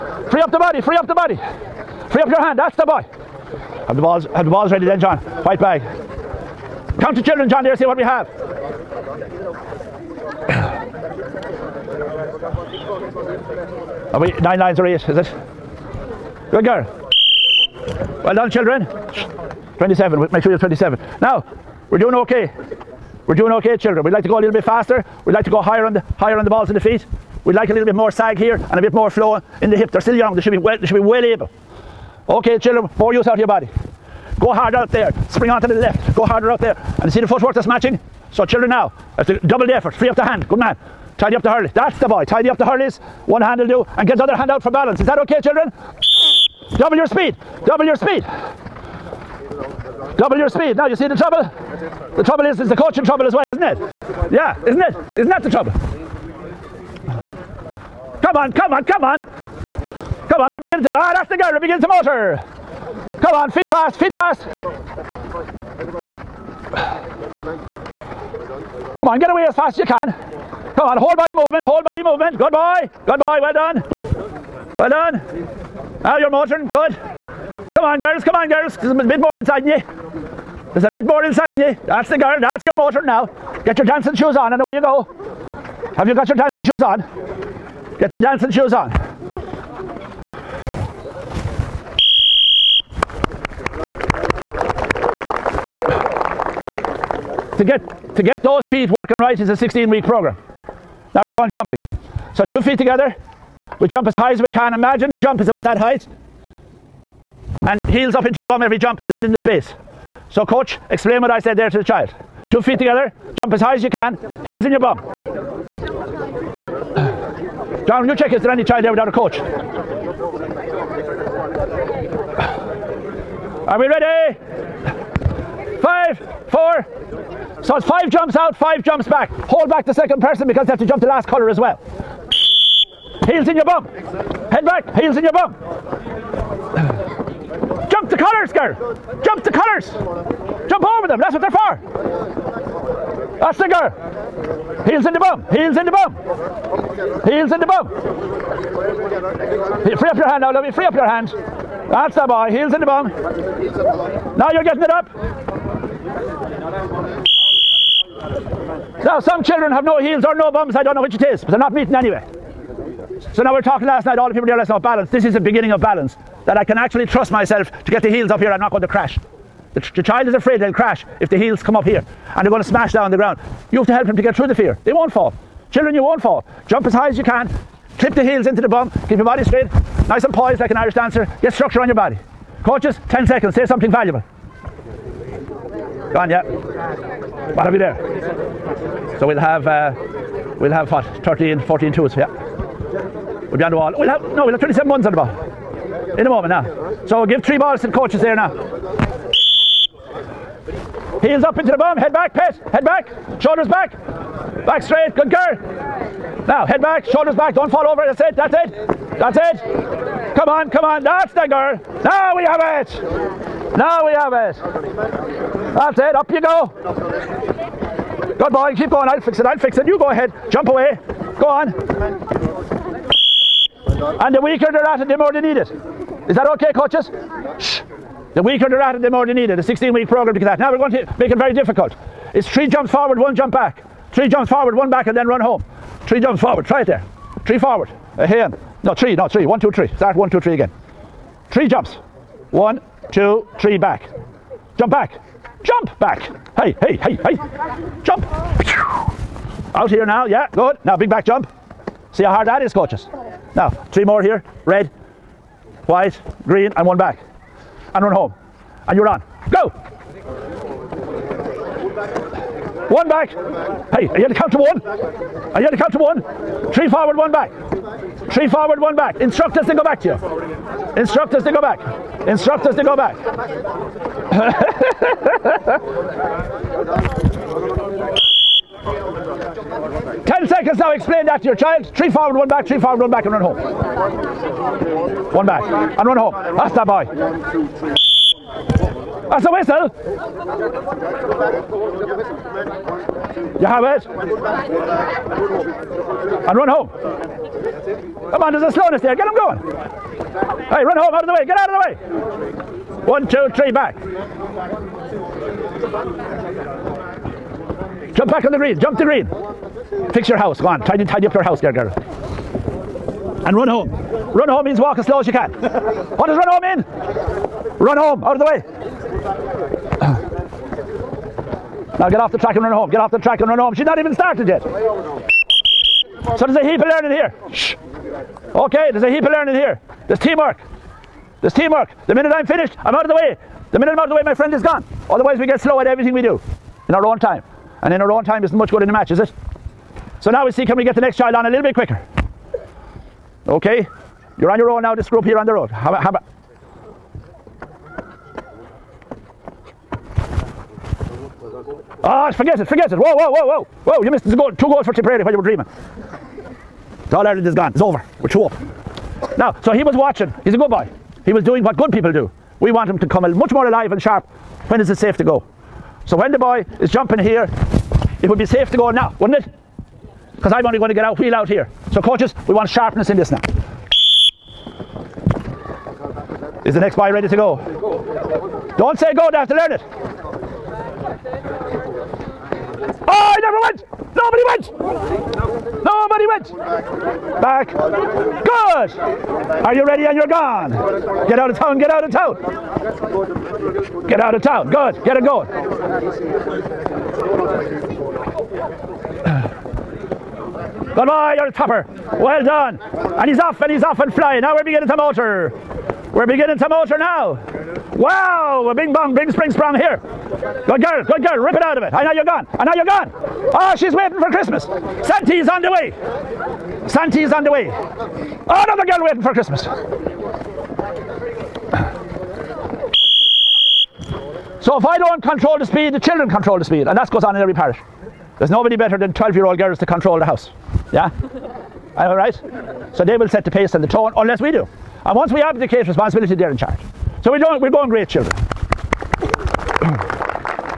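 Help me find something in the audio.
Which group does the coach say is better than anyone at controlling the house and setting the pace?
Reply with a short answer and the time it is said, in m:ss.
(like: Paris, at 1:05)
12 year old girls, at 7:09.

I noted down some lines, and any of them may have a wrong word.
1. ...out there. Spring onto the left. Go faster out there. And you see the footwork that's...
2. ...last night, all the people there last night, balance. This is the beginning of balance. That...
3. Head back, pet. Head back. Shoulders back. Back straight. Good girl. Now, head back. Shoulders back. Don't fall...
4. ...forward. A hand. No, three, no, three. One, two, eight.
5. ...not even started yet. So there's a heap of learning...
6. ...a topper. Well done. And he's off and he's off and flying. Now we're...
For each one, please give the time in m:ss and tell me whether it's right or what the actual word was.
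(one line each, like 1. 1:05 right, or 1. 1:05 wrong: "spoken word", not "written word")
1. 0:34 wrong: "harder", not "faster"
2. 2:43 right
3. 3:21 right
4. 3:57 wrong: "three", not "eight"
5. 5:23 right
6. 6:41 right.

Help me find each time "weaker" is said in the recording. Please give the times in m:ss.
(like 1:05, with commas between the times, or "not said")
3:44, 3:48.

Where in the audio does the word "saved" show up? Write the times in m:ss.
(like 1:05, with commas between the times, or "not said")
not said.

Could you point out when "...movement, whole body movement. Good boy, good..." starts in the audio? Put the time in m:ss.
1:11.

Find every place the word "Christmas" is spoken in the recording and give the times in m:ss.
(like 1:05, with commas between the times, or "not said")
6:54, 6:59.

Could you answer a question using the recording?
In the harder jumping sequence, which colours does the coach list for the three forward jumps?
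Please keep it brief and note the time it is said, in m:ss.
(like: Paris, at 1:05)
Red, white, green, at 4:14.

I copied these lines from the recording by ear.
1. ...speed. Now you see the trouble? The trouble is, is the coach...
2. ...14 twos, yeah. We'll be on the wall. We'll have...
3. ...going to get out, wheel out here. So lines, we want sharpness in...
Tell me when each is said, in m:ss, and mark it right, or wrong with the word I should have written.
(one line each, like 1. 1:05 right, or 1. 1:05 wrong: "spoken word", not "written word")
1. 0:50 right
2. 3:11 right
3. 6:10 wrong: "coaches", not "lines".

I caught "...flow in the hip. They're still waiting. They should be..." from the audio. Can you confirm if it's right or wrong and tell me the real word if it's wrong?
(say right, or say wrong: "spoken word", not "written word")
wrong: "young", not "waiting".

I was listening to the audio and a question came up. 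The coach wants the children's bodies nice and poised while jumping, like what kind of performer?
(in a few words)
Irish dancer.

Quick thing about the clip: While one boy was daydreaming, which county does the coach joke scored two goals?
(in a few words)
Tipperary.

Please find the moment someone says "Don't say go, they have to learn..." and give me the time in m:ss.
6:18.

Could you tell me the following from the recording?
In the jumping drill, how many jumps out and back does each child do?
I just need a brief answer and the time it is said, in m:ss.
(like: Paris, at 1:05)
5, at 2:07.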